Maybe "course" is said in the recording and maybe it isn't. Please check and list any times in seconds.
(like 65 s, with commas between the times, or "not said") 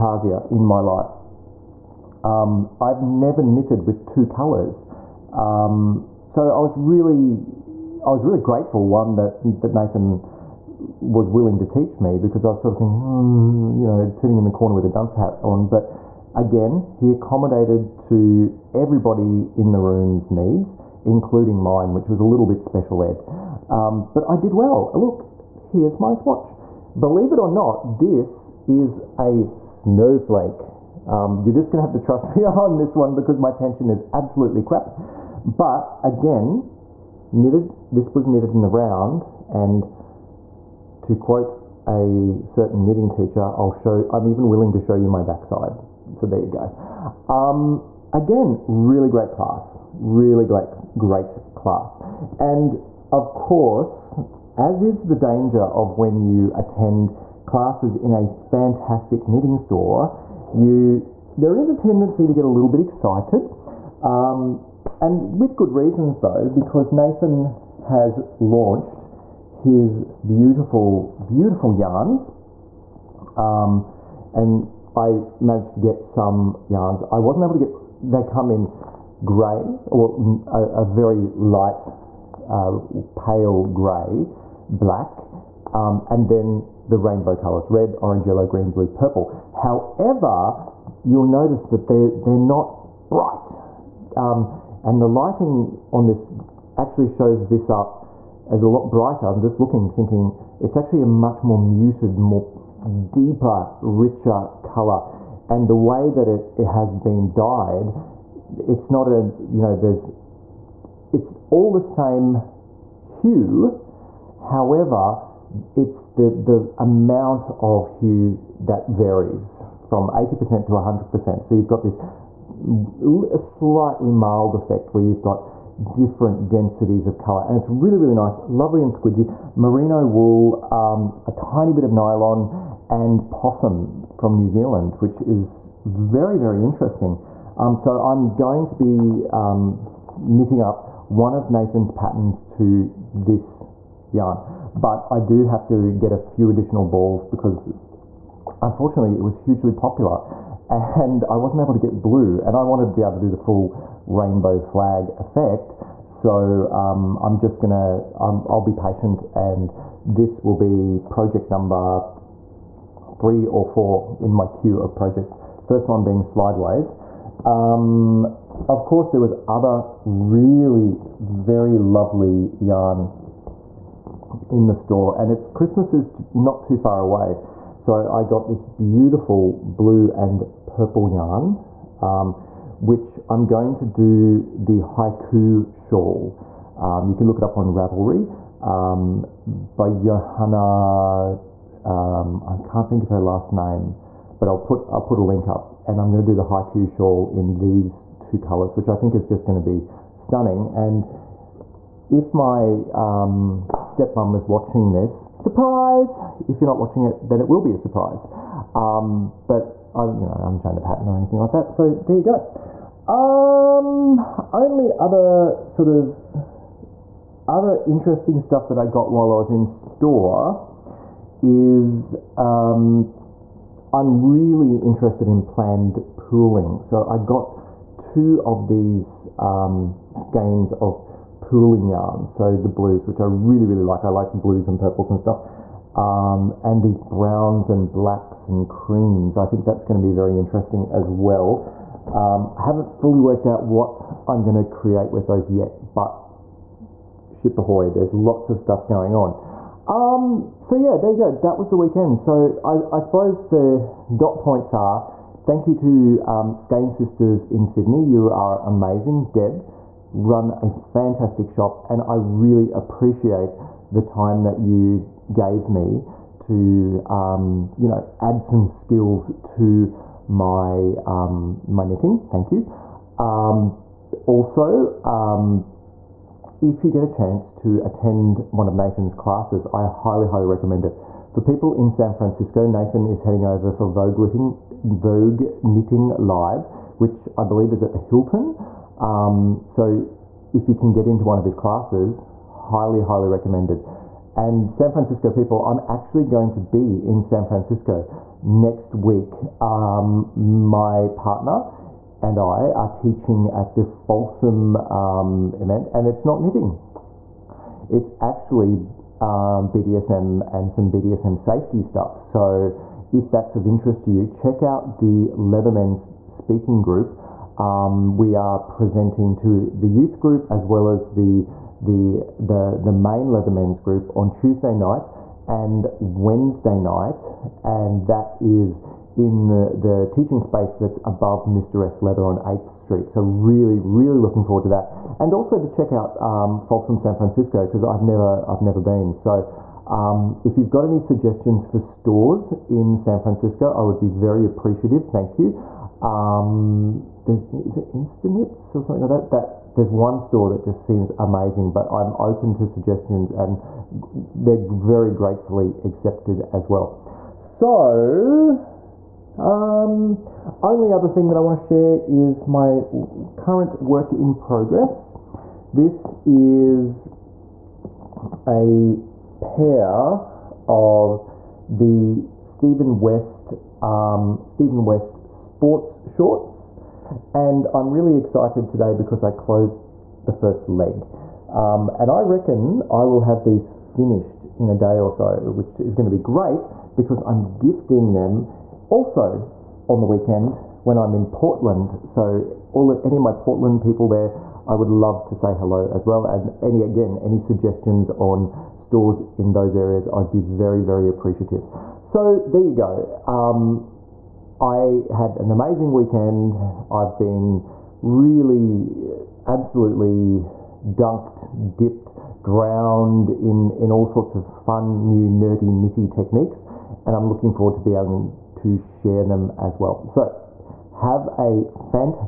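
53 s, 168 s.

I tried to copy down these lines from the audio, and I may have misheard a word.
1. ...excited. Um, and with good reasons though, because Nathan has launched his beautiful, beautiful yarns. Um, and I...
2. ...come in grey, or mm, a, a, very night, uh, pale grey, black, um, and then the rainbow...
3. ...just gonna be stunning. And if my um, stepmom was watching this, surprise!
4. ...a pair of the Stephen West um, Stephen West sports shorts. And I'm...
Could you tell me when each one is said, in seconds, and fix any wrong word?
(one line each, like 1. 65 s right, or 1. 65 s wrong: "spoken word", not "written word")
1. 62 s right
2. 78 s wrong: "light", not "night"
3. 199 s right
4. 368 s right.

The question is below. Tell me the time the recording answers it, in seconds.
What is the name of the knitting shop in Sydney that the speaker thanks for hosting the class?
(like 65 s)
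256 s.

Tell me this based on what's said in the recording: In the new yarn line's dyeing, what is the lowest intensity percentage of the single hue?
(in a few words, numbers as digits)
80%.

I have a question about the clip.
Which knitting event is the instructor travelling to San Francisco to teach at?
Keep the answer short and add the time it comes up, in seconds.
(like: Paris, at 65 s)
Vogue Knitting Live, at 284 s.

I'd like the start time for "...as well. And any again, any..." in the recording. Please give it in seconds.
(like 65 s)
395 s.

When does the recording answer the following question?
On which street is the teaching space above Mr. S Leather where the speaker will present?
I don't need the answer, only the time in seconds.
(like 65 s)
332 s.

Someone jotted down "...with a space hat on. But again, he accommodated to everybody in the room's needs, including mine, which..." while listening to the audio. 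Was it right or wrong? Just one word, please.
wrong.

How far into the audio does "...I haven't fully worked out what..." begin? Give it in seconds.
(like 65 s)
242 s.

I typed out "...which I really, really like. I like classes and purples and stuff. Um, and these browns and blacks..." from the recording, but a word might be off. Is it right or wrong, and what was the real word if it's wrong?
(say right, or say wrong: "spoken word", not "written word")
wrong: "blues", not "classes".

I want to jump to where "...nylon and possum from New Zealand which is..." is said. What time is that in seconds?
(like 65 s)
131 s.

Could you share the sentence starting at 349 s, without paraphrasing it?
That there's one store that just seems amazing, but I'm open to suggestions and they're very gratefully accepted as well.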